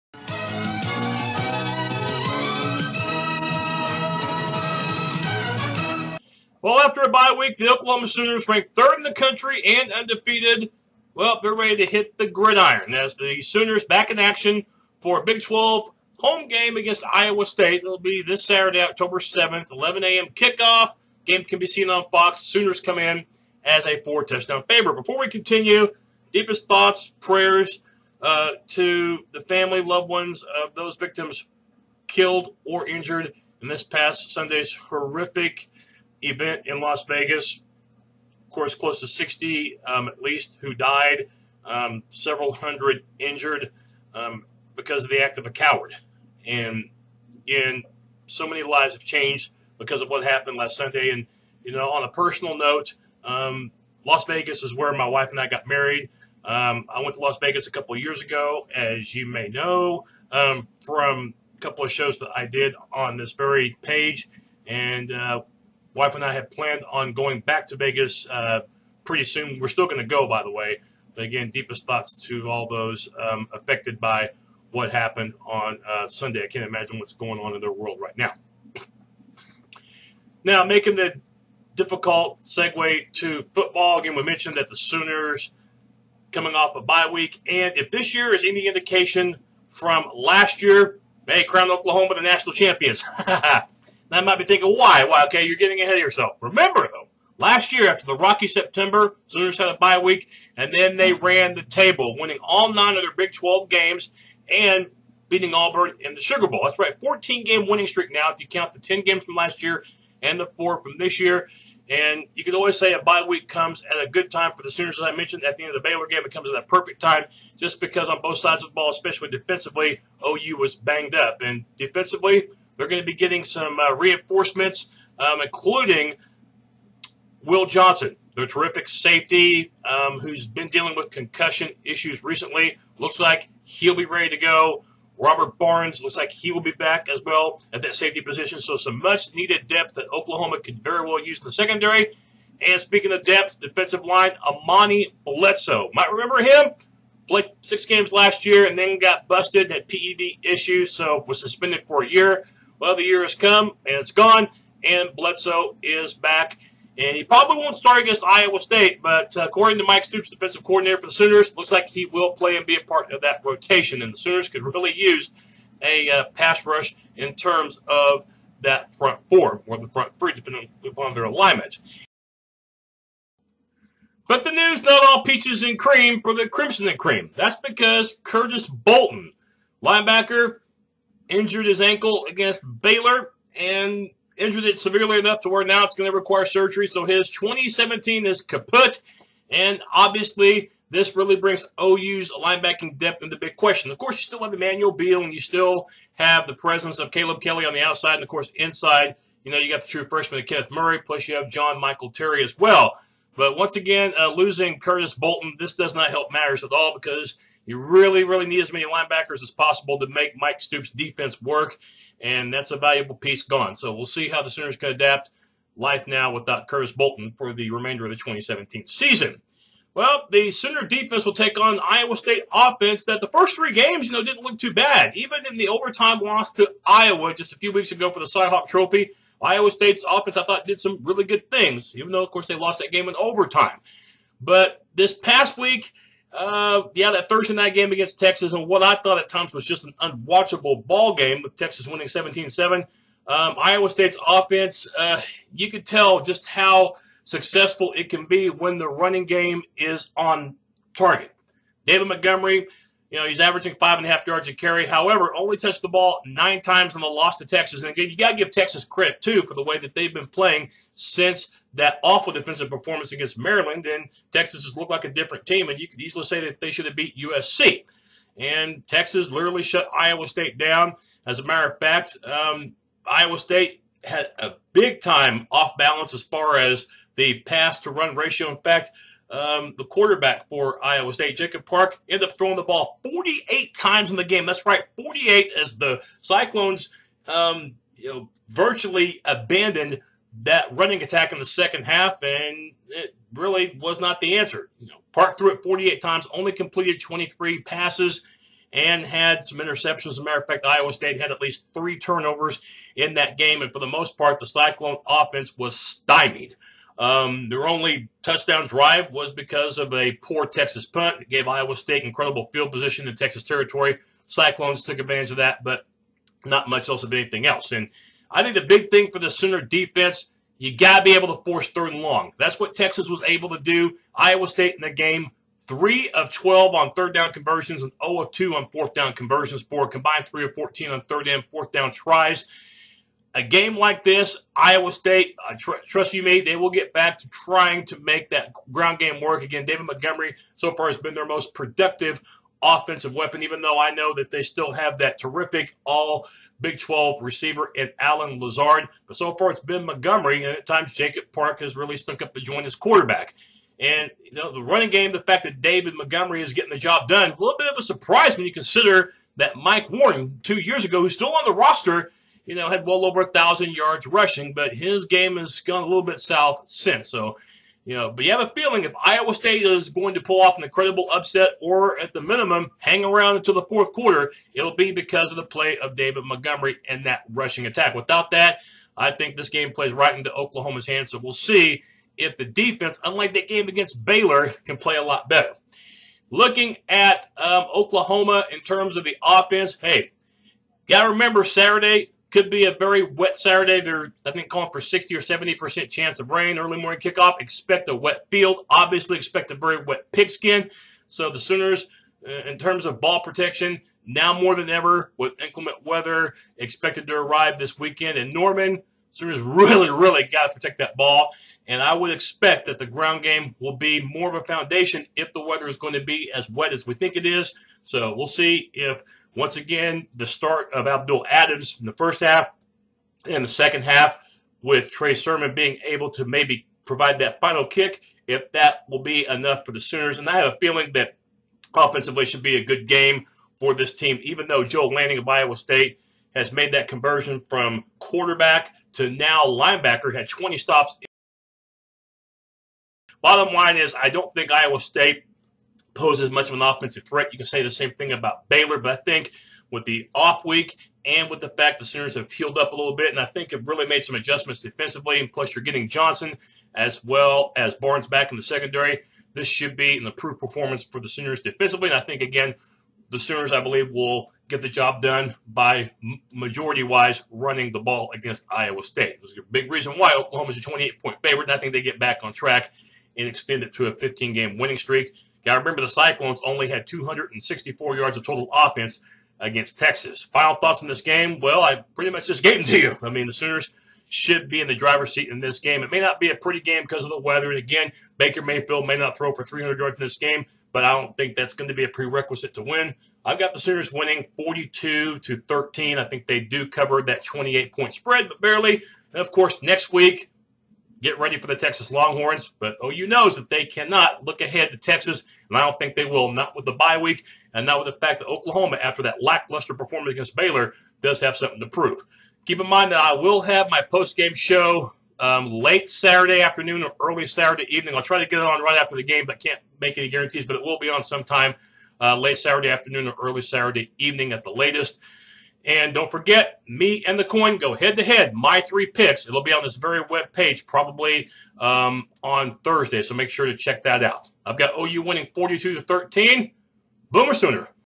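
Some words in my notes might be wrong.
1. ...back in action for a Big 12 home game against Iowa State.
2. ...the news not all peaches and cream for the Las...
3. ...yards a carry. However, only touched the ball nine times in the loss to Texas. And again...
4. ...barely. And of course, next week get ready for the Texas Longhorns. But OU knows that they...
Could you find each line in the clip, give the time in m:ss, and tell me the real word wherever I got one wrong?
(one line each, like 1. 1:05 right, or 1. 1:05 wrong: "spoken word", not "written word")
1. 0:13 right
2. 2:54 wrong: "Crimson", not "Las"
3. 4:14 right
4. 8:18 right.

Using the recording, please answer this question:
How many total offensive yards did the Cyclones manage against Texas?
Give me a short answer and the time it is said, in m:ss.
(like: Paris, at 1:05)
264, at 7:56.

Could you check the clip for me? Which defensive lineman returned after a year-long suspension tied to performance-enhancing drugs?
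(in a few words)
Amani Bledsoe.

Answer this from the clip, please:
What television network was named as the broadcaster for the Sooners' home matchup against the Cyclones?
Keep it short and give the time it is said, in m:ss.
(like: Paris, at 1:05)
Fox, at 0:22.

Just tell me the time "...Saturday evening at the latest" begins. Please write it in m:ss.
8:43.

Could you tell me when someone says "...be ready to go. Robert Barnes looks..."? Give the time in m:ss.
2:13.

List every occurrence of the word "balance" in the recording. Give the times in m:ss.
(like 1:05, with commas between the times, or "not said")
4:35.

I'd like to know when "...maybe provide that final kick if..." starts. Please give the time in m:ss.
7:06.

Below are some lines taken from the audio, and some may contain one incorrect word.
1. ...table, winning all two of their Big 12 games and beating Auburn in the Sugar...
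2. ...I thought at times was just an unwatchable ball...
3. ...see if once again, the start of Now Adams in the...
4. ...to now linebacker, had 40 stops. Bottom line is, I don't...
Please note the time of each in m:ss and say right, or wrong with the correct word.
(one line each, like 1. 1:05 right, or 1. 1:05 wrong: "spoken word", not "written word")
1. 1:41 wrong: "nine", not "two"
2. 3:58 right
3. 6:58 wrong: "Abdul", not "Now"
4. 7:18 wrong: "20", not "40".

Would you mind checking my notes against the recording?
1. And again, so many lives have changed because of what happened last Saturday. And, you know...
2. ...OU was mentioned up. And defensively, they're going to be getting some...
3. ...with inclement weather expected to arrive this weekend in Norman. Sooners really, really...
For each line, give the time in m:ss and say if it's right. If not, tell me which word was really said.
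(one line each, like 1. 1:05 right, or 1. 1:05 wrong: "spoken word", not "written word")
1. 0:46 wrong: "Sunday", not "Saturday"
2. 2:00 wrong: "banged", not "mentioned"
3. 6:45 right.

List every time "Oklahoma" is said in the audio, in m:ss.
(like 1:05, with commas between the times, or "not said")
0:07, 1:31, 2:20, 6:20, 6:27, 7:50, 8:28.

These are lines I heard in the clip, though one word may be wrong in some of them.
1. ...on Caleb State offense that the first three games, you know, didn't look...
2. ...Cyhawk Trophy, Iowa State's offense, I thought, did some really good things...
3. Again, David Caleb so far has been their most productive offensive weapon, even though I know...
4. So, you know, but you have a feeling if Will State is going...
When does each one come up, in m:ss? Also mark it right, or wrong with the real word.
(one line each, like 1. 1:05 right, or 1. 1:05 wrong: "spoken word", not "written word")
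1. 3:41 wrong: "Iowa", not "Caleb"
2. 3:48 right
3. 5:39 wrong: "Montgomery", not "Caleb"
4. 6:07 wrong: "Iowa", not "Will".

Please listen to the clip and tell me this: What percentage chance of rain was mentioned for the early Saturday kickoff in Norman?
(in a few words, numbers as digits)
60 or 70%.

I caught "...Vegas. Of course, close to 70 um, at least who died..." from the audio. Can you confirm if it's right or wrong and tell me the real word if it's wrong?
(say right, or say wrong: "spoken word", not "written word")
wrong: "60", not "70".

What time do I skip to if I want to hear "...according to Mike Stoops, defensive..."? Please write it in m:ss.
2:39.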